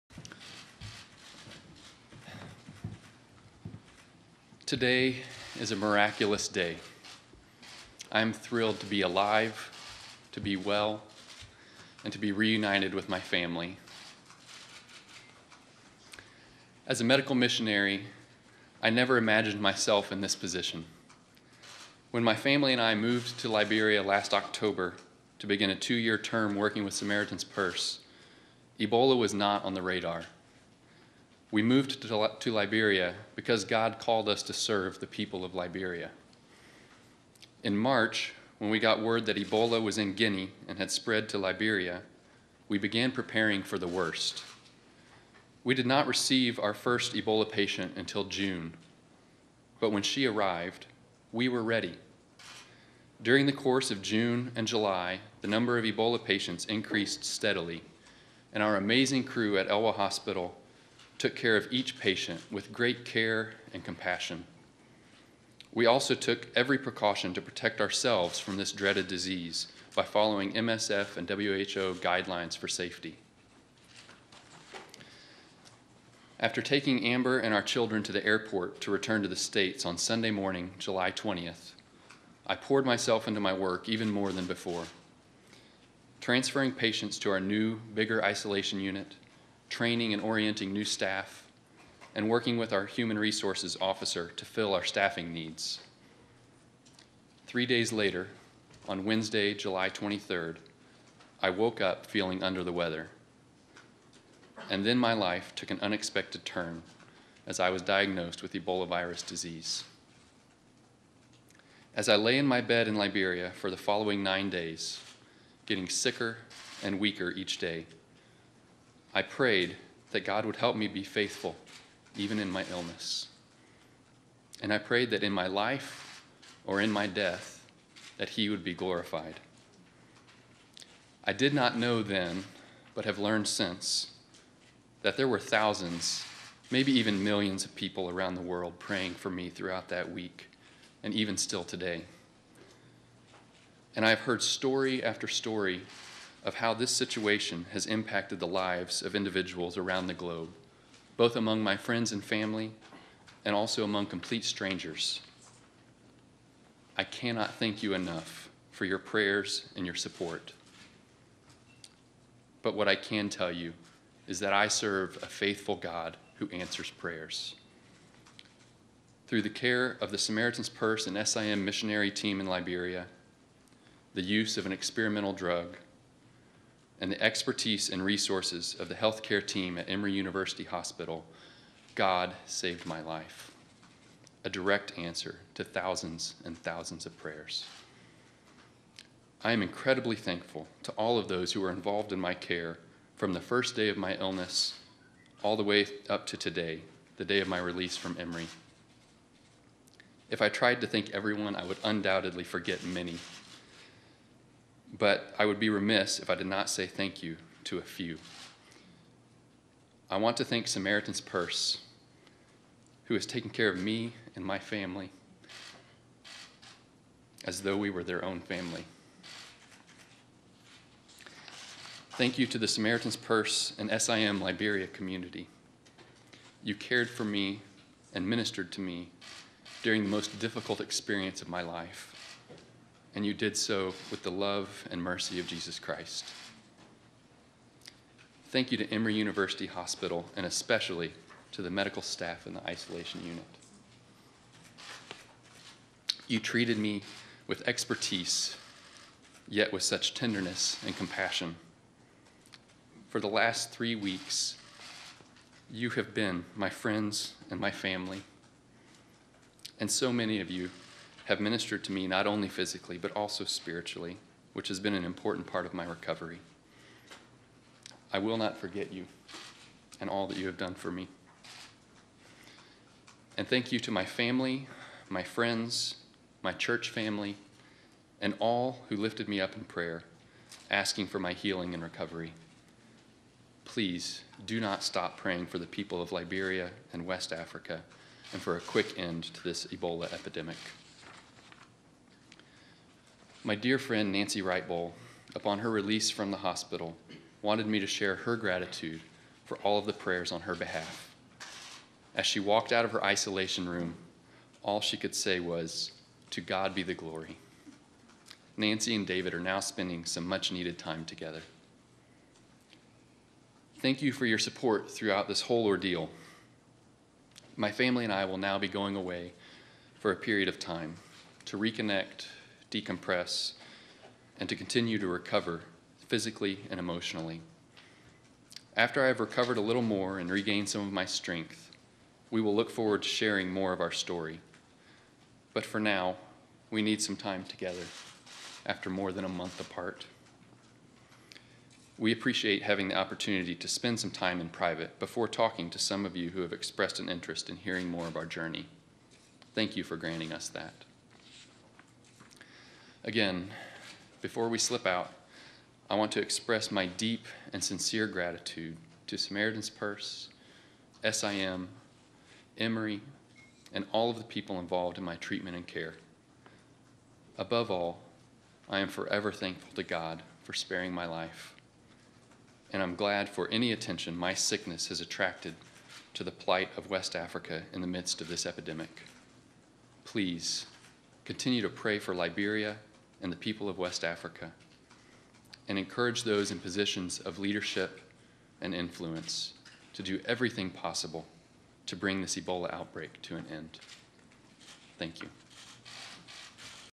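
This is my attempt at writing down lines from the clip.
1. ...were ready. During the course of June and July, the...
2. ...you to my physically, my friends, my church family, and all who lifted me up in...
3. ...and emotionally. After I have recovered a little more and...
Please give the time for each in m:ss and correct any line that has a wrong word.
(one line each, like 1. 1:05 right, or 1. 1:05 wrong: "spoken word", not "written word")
1. 0:51 right
2. 4:33 wrong: "family", not "physically"
3. 5:26 right.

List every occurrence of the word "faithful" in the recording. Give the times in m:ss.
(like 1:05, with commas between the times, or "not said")
2:01, 2:45.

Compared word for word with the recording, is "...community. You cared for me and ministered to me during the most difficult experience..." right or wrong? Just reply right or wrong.
right.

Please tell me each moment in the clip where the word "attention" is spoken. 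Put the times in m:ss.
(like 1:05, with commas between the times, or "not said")
6:13.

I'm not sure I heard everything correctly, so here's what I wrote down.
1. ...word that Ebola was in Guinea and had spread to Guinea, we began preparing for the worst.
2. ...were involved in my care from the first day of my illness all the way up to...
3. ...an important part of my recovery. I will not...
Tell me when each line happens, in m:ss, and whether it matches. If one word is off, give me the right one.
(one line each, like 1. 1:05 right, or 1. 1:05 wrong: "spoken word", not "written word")
1. 0:39 wrong: "Liberia", not "Guinea"
2. 3:11 right
3. 4:24 right.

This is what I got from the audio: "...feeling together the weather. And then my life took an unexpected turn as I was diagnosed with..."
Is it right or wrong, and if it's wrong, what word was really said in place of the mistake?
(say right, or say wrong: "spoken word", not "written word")
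wrong: "under", not "together".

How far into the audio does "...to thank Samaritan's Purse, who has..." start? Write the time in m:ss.
3:30.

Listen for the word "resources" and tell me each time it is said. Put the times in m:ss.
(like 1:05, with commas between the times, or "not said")
1:33, 2:58.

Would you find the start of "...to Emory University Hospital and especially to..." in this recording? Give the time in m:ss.
3:58.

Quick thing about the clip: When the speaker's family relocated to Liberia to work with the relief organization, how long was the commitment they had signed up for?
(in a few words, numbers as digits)
2 years.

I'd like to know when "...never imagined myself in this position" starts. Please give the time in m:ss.
0:18.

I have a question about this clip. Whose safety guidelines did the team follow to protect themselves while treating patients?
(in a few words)
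MSF and WHO.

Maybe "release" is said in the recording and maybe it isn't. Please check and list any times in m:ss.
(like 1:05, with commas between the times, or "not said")
3:17, 4:55.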